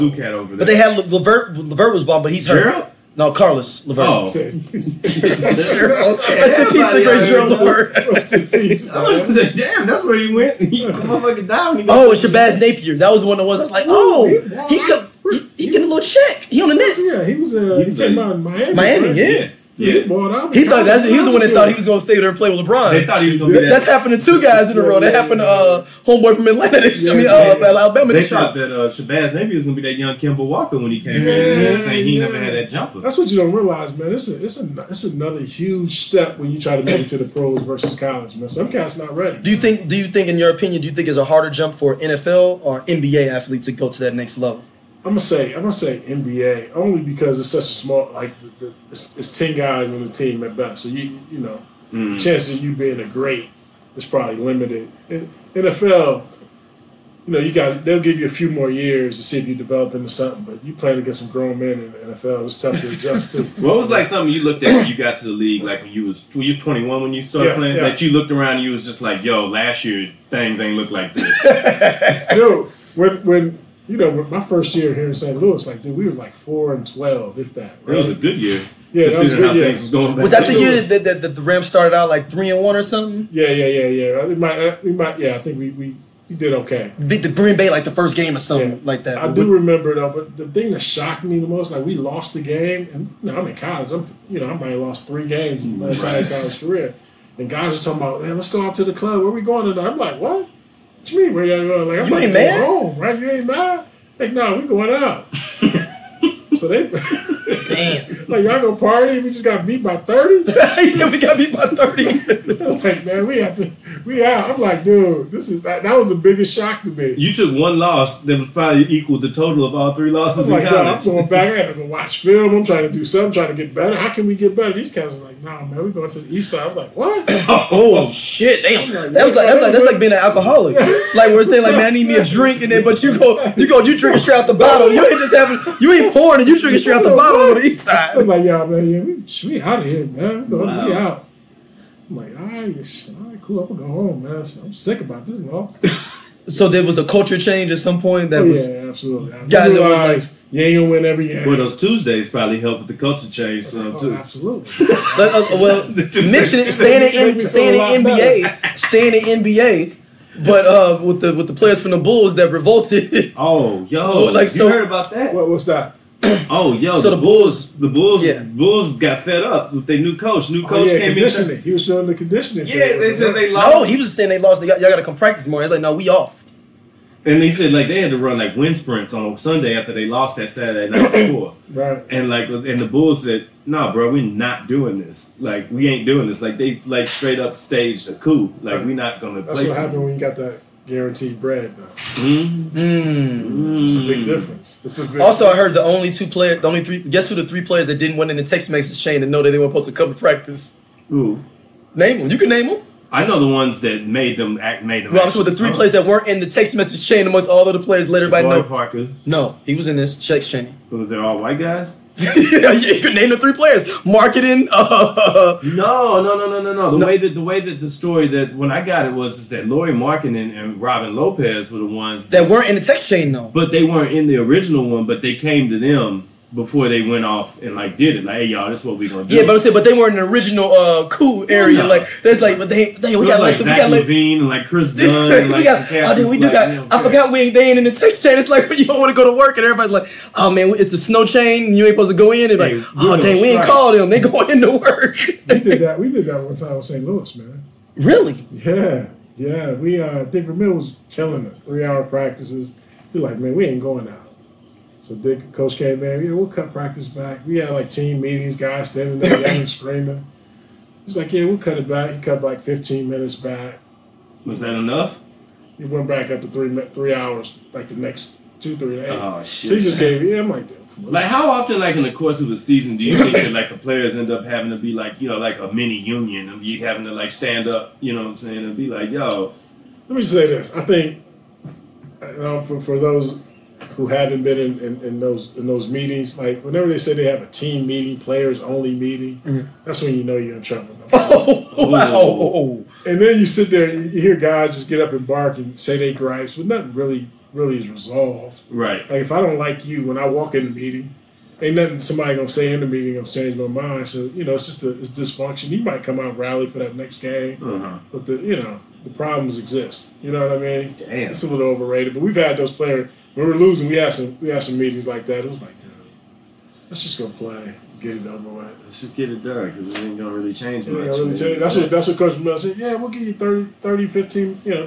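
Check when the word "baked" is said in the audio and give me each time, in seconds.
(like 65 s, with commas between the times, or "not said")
not said.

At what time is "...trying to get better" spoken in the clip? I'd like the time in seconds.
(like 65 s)
123 s.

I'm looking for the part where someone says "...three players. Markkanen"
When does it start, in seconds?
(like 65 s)
213 s.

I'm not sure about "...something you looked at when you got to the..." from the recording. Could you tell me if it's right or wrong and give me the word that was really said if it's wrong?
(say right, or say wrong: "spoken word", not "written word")
right.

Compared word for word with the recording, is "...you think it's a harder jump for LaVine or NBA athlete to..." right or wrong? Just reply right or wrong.
wrong.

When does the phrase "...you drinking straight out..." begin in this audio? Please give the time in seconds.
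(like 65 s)
136 s.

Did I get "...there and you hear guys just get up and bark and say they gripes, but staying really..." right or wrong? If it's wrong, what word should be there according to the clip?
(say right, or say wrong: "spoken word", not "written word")
wrong: "nothing", not "staying".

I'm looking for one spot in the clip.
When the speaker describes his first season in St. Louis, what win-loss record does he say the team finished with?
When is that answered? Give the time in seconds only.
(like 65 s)
76 s.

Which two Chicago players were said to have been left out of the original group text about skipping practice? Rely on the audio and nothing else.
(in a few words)
Lauri Markkanen and Robin Lopez.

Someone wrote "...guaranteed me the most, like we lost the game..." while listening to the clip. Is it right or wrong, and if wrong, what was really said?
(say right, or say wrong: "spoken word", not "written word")
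wrong: "shocked", not "guaranteed".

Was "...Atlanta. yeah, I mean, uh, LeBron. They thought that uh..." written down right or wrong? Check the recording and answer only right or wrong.
wrong.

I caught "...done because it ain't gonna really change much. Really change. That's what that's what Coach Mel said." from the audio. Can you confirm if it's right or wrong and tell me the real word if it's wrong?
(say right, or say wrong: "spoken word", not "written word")
right.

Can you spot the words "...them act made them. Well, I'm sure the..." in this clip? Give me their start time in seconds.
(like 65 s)
204 s.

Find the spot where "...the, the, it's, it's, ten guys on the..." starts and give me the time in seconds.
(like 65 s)
48 s.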